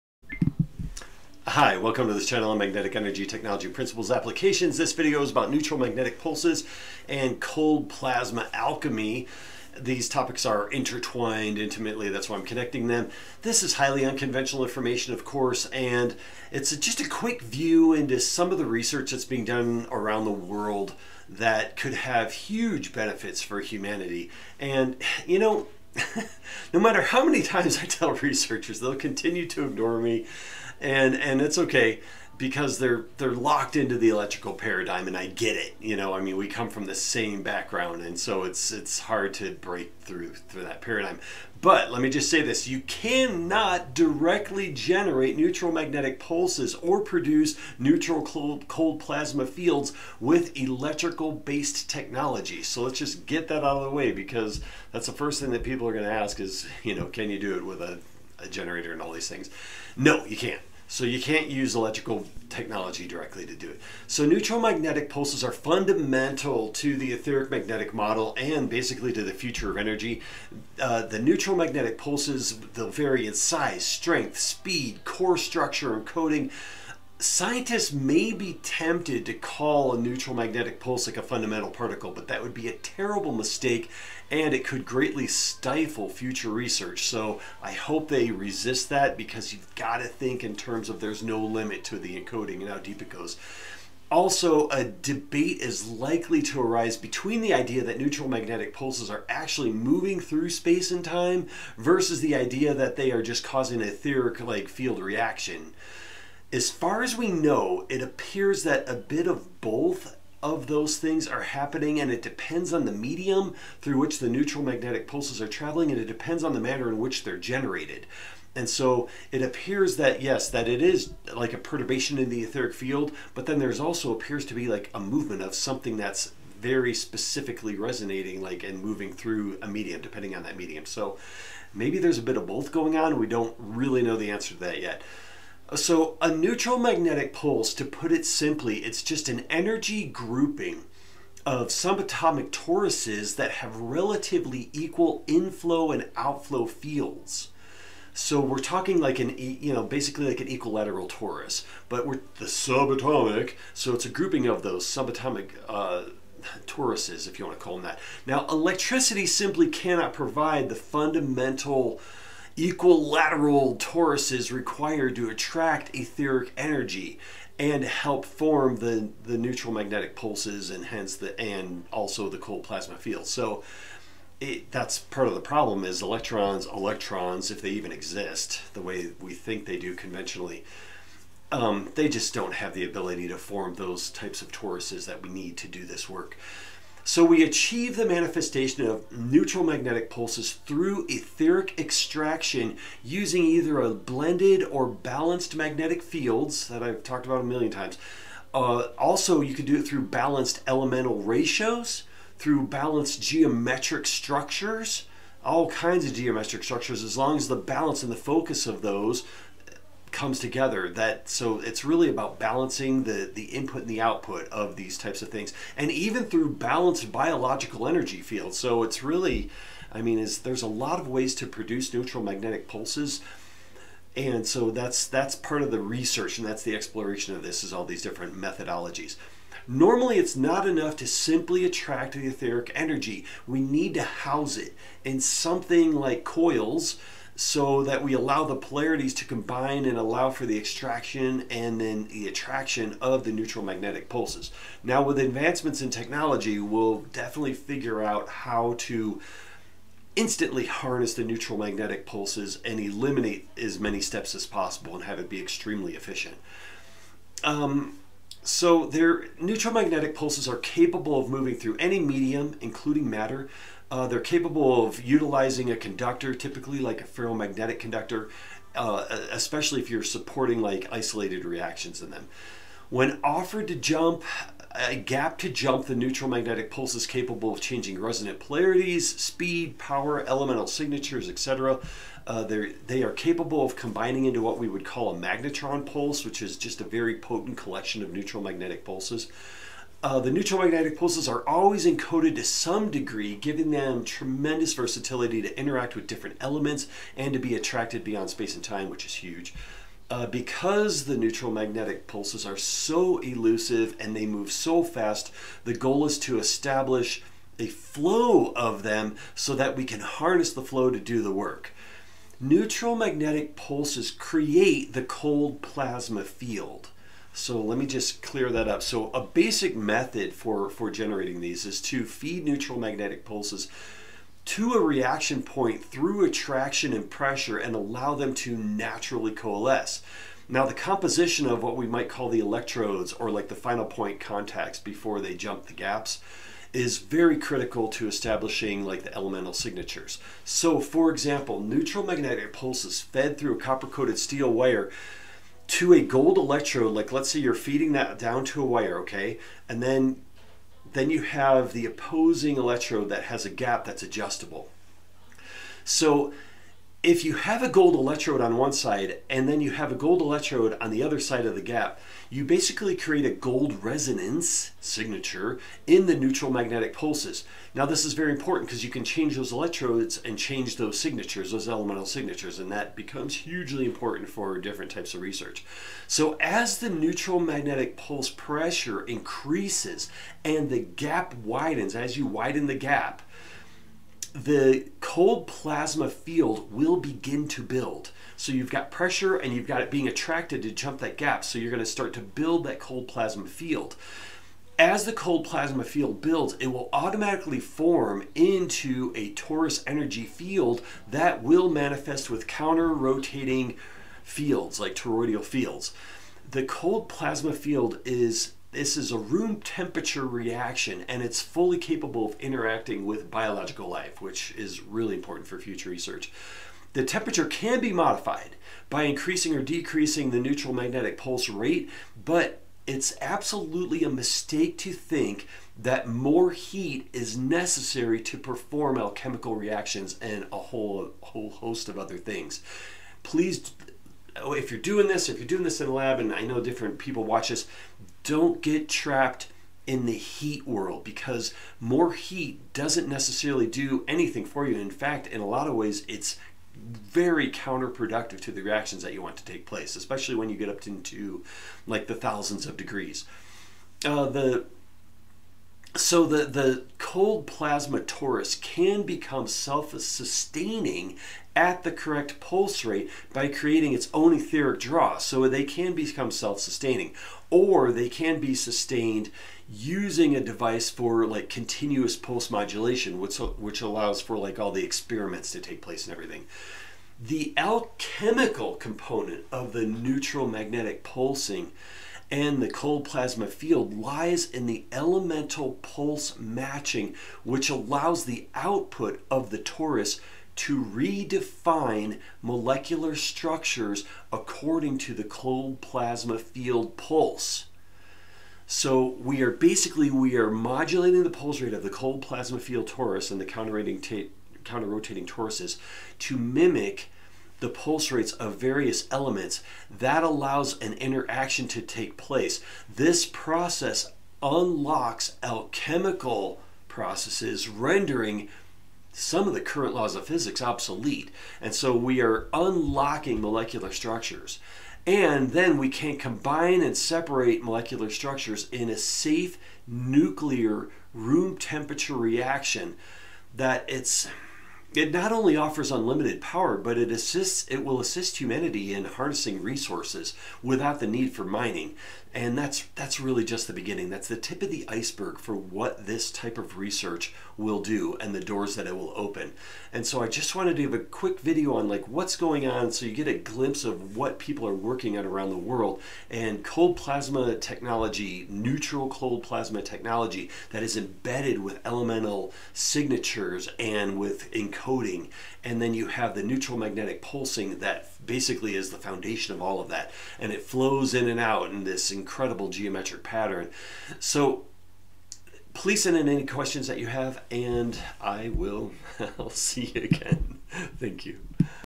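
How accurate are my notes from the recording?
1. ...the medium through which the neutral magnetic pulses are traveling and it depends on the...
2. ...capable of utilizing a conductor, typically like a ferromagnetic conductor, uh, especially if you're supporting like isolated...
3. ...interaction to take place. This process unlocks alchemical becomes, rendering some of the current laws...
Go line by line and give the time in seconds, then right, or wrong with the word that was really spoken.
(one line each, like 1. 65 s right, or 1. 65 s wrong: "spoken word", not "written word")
1. 112 s right
2. 264 s right
3. 510 s wrong: "processes", not "becomes".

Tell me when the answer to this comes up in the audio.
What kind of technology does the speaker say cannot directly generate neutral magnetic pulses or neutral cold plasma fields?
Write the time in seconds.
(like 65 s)
50 s.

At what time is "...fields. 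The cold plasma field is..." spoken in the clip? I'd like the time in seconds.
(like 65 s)
405 s.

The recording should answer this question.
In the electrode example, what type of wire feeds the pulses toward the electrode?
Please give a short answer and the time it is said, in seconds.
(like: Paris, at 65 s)
Copper coated steel wire, at 343 s.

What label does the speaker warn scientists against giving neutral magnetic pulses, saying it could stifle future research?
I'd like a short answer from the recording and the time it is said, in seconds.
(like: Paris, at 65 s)
Fundamental particle, at 81 s.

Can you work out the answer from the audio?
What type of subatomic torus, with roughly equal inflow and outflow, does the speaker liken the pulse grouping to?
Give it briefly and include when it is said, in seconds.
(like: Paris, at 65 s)
Equilateral torus, at 150 s.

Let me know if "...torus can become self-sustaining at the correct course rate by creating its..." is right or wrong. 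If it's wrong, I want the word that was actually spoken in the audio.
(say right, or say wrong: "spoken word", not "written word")
wrong: "pulse", not "course".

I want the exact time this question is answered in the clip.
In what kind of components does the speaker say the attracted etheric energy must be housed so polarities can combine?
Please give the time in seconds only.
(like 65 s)
236 s.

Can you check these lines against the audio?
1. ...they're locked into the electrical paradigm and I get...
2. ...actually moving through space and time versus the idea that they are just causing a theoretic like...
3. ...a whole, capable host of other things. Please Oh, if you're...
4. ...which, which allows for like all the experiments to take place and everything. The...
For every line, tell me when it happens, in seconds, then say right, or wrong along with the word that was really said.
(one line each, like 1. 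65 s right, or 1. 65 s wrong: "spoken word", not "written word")
1. 33 s right
2. 99 s right
3. 430 s wrong: "whole", not "capable"
4. 473 s right.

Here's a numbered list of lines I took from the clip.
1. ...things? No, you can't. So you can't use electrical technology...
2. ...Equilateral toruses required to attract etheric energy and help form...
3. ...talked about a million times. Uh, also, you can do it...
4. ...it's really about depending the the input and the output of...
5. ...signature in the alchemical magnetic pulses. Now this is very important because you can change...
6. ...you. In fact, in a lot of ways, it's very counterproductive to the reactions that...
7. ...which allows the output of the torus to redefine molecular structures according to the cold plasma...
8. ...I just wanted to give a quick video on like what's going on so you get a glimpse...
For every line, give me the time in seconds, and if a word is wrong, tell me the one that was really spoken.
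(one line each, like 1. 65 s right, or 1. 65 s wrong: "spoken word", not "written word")
1. 59 s right
2. 162 s right
3. 197 s right
4. 211 s wrong: "balancing", not "depending"
5. 364 s wrong: "neutral", not "alchemical"
6. 444 s right
7. 487 s right
8. 550 s right.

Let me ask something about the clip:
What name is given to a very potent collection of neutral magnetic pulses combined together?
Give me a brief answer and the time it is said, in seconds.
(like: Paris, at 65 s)
Magnetron pulse, at 285 s.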